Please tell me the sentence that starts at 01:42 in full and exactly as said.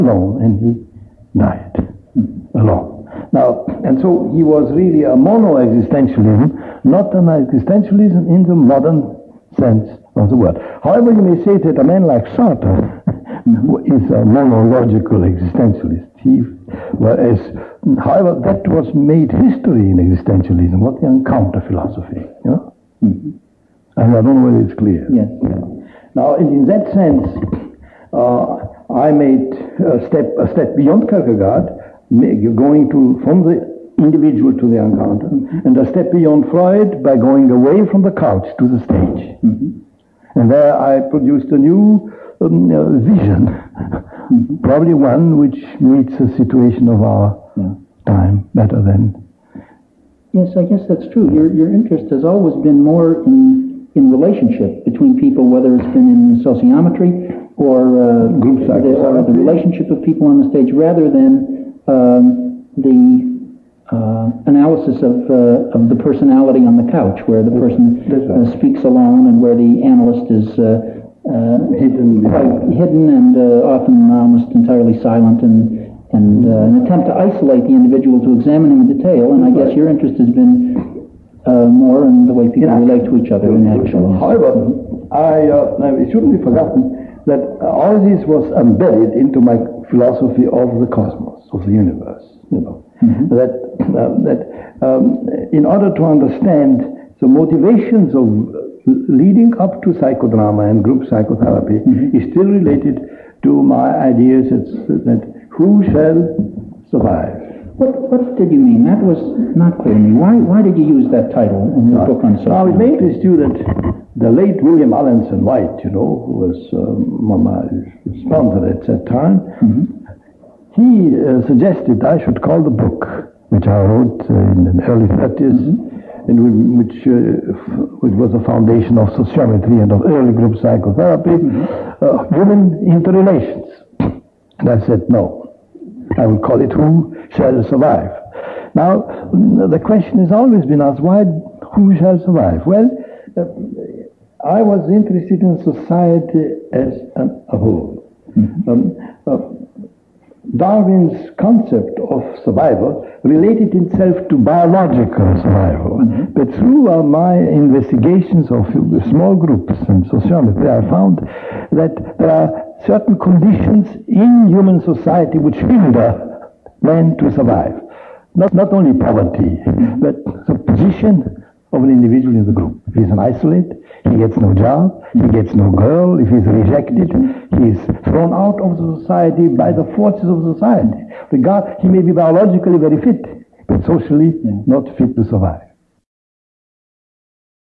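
is still related to my ideas that who shall survive.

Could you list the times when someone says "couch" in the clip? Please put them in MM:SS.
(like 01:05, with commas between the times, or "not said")
00:38, 01:06.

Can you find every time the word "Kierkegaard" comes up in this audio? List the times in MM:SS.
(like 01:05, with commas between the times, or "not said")
00:31.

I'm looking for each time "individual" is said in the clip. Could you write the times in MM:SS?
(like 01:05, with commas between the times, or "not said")
00:33, 01:17, 02:51.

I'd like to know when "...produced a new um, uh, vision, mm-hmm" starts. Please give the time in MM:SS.
00:41.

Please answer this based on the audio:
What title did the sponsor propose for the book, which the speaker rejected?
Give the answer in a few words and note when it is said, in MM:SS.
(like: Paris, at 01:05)
Human interrelations, at 02:12.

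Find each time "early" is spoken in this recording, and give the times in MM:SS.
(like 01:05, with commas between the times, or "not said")
02:04, 02:10.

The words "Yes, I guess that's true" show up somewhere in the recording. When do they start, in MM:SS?
00:50.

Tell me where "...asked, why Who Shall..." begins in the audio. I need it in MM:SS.
02:20.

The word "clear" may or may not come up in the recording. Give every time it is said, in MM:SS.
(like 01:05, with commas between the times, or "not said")
00:24, 01:49.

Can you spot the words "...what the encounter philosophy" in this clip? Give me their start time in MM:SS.
00:20.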